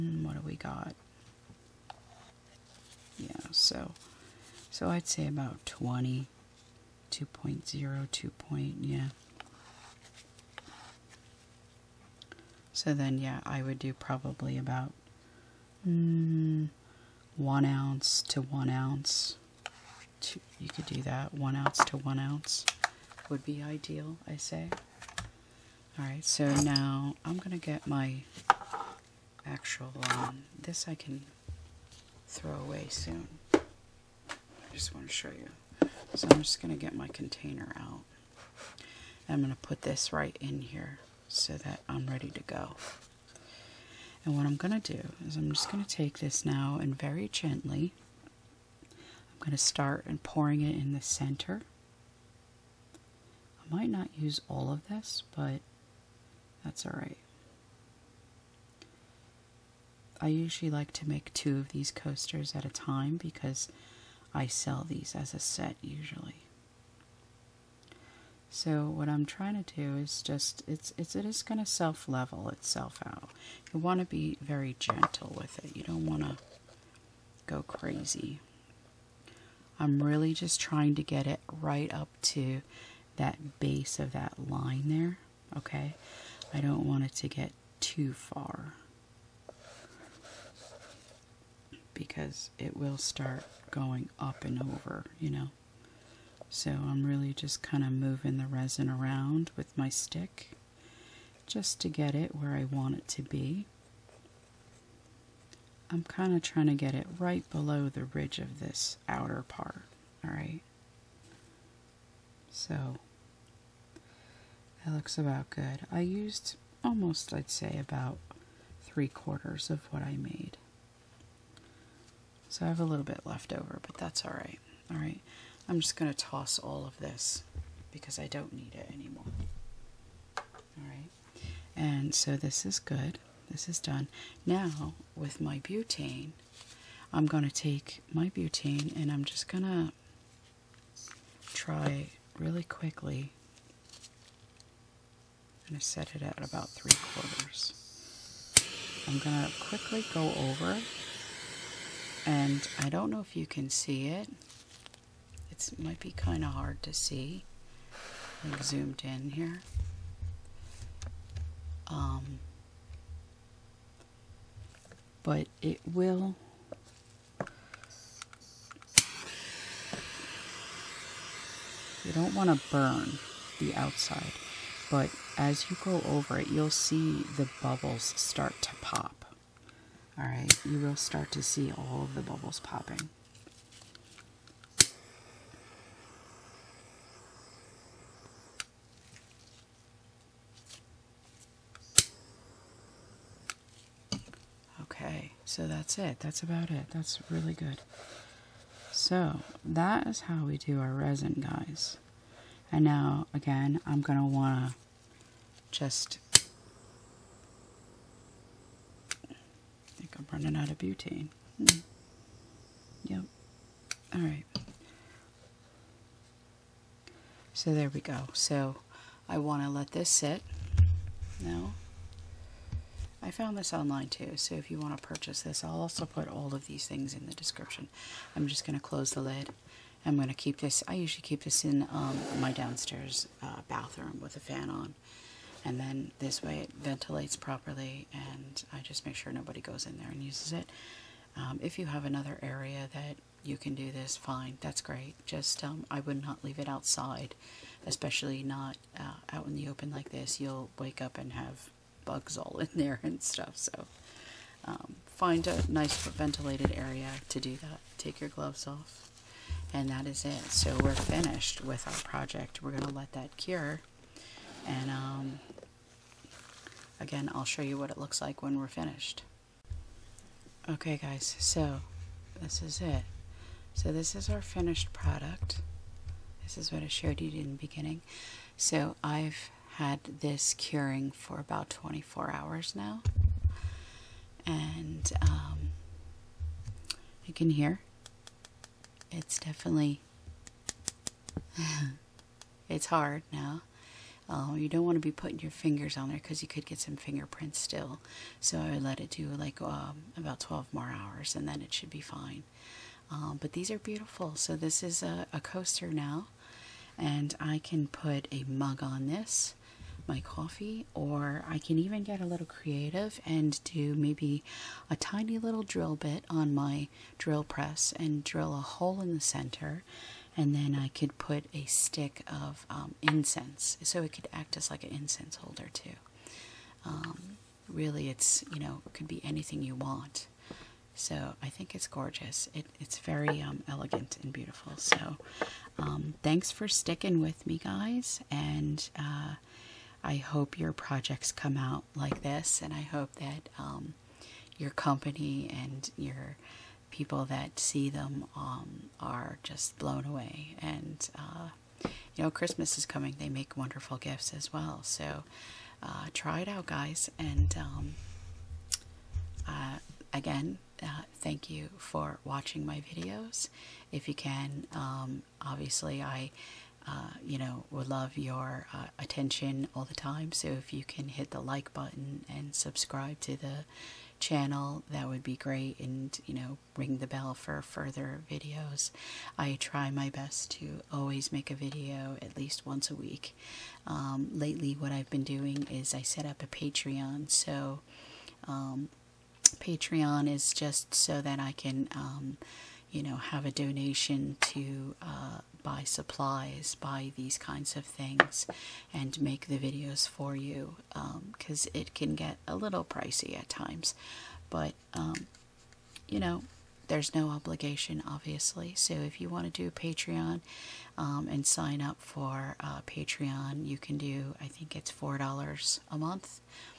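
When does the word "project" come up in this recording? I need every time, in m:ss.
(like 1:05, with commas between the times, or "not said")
4:22, 5:40.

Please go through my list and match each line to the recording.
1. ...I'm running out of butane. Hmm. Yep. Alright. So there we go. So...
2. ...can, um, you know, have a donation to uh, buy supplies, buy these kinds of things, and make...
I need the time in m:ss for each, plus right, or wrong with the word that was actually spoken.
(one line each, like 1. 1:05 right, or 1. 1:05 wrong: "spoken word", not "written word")
1. 3:30 right
2. 6:31 right.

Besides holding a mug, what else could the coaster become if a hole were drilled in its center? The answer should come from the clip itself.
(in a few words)
incense holder.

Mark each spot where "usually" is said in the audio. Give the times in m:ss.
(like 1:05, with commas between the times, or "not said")
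1:00, 1:05, 3:50.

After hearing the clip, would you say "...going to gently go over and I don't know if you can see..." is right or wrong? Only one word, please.
wrong.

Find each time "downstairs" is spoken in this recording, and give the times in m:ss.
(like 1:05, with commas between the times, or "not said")
3:52.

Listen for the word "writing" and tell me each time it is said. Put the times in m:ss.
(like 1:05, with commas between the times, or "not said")
not said.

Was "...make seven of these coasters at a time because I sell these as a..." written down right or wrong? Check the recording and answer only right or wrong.
wrong.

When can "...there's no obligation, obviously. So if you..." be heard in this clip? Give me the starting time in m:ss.
6:46.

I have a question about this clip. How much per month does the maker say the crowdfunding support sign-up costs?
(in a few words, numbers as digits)
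$4.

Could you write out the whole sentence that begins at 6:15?
And, you know, ring the bell for further videos.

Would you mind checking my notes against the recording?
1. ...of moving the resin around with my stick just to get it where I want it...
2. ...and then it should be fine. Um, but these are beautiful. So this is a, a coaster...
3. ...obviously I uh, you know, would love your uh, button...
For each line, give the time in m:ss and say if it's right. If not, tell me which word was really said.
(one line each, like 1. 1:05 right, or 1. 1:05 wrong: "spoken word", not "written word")
1. 1:37 right
2. 5:01 right
3. 6:05 wrong: "attention", not "button".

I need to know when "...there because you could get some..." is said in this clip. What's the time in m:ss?
4:56.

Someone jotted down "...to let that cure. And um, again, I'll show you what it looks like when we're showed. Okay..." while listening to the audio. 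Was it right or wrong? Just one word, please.
wrong.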